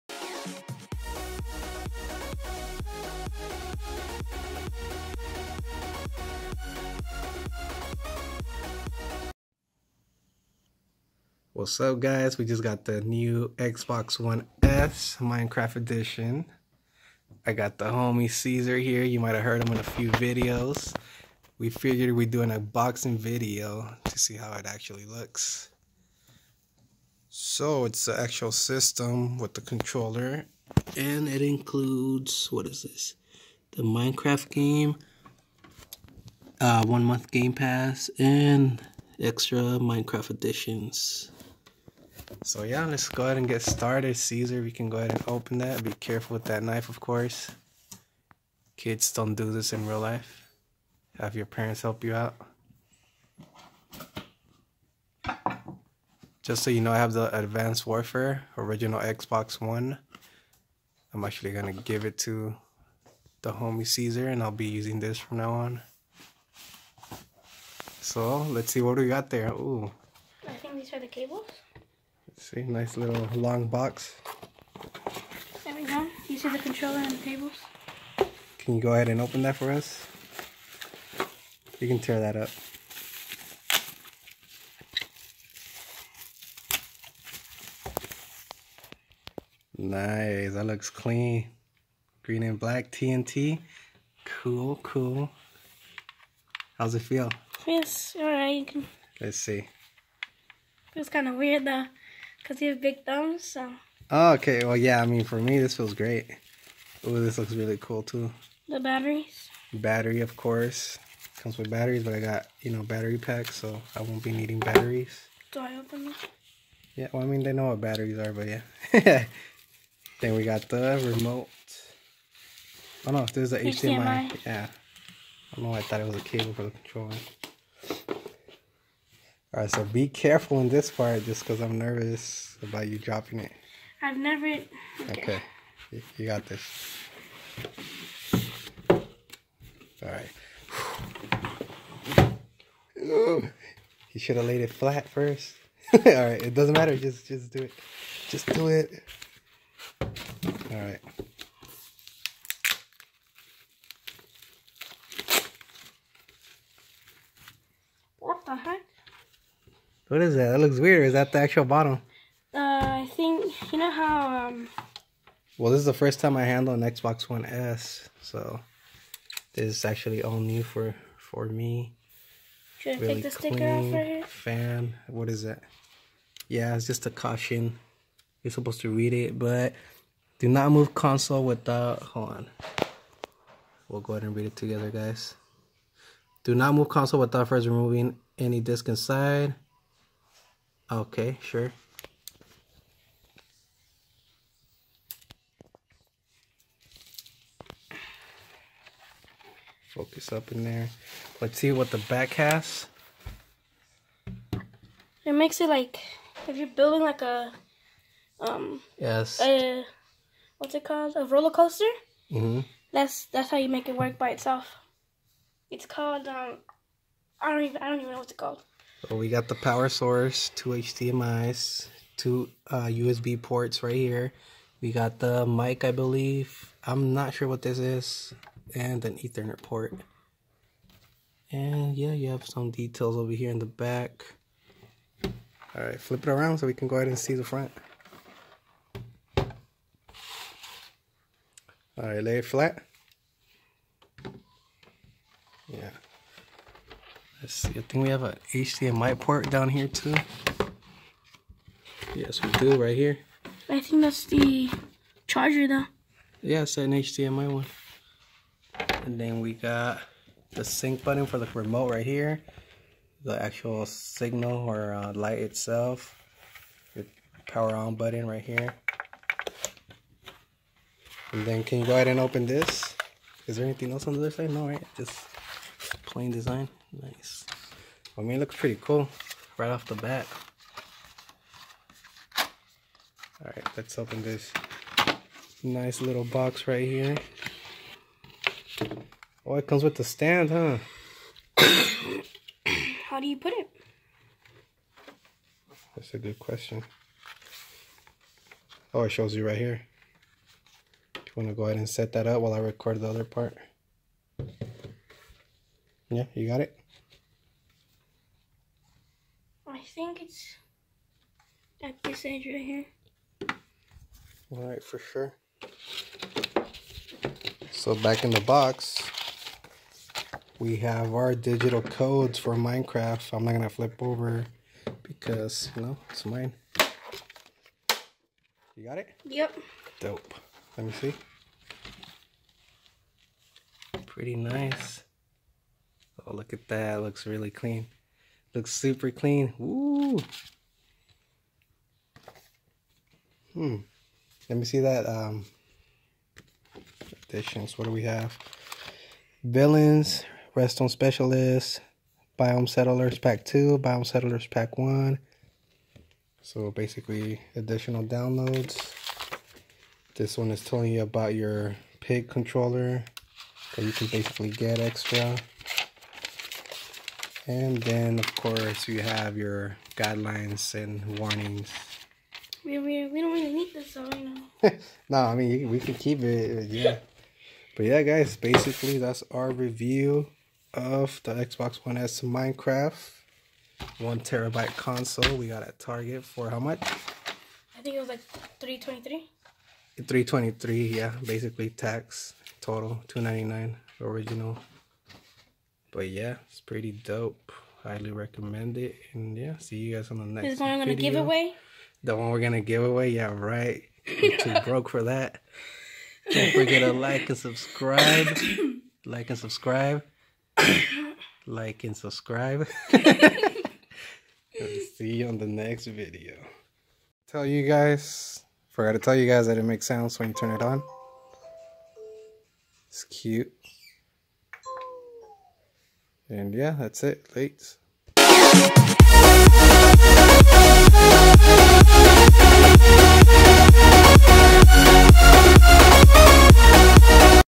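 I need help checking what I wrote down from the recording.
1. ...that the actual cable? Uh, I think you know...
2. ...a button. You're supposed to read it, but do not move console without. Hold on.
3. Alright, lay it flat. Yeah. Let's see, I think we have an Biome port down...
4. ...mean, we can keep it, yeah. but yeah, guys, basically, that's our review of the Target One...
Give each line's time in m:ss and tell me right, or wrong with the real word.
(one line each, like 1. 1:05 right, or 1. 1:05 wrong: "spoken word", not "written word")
1. 2:41 wrong: "bottle", not "cable"
2. 2:57 wrong: "caution", not "button"
3. 4:01 wrong: "HDMI", not "Biome"
4. 6:15 wrong: "Xbox", not "Target".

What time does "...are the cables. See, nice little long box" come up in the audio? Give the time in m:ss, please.
1:10.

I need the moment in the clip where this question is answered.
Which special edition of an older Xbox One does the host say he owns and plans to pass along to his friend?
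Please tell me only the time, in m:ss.
0:57.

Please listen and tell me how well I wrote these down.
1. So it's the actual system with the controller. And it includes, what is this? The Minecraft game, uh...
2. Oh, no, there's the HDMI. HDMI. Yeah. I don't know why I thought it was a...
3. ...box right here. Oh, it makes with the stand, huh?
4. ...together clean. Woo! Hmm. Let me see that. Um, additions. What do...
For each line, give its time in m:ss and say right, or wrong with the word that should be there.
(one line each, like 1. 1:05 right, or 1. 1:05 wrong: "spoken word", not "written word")
1. 0:27 right
2. 2:03 right
3. 4:46 wrong: "comes", not "makes"
4. 5:38 wrong: "super", not "together".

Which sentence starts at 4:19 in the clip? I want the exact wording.
And then we got the sync button for the remote right here.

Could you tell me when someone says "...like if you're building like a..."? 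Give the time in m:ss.
3:25.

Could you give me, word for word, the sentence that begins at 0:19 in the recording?
You might have heard him in a few videos.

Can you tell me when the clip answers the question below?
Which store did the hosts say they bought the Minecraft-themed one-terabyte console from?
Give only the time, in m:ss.
6:25.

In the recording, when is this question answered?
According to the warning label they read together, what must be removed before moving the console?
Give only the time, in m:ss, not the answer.
3:08.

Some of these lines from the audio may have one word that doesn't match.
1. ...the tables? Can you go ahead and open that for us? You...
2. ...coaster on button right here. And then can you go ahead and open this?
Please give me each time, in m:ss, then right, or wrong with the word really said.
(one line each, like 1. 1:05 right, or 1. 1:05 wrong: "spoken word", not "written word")
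1. 1:17 right
2. 4:27 wrong: "power", not "coaster".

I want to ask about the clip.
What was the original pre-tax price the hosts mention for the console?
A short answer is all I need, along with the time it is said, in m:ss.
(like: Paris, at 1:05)
299, at 6:33.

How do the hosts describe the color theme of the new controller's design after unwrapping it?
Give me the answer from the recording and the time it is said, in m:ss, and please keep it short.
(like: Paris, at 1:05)
Green and black TNT, at 1:32.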